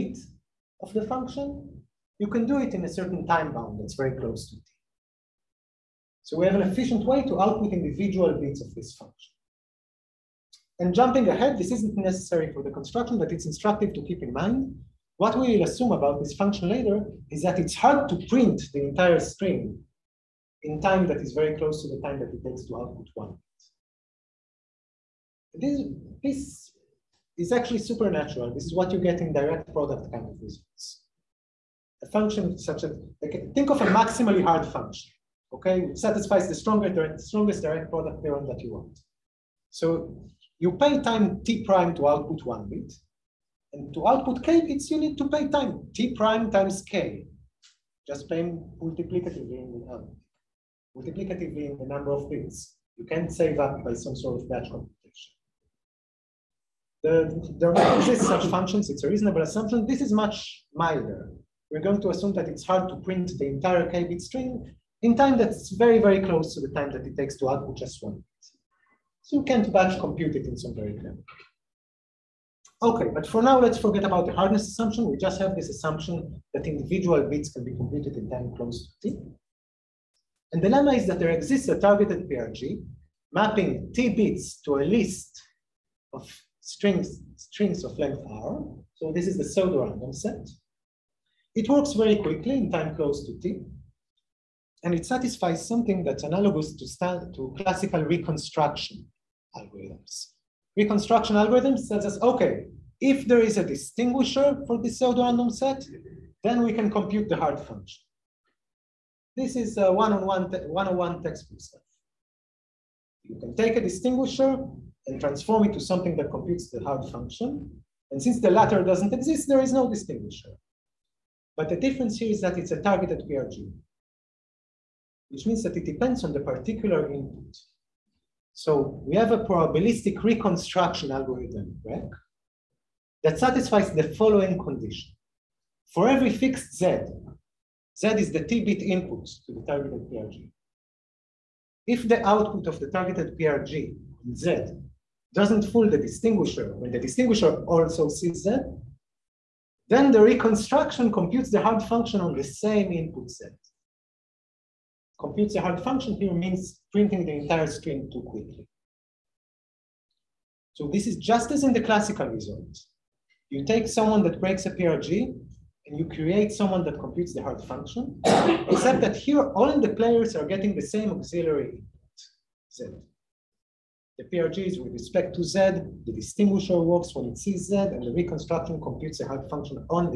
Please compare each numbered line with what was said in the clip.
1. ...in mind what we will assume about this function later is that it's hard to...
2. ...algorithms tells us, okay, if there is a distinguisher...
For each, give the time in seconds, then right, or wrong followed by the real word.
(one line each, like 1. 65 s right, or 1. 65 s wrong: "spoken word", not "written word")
1. 14 s right
2. 101 s right.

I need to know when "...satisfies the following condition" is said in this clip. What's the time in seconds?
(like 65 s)
133 s.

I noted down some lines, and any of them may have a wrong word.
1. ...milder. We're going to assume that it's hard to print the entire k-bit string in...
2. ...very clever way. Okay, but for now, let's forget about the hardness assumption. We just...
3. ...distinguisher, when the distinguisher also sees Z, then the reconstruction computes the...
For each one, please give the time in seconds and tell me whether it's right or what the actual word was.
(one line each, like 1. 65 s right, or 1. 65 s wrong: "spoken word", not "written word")
1. 60 s right
2. 70 s right
3. 145 s right.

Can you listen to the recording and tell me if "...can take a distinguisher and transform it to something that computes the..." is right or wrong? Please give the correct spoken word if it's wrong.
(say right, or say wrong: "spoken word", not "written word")
right.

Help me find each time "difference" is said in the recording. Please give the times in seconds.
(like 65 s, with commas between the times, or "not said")
121 s.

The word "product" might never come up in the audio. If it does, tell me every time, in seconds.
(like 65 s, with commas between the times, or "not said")
29 s, 37 s.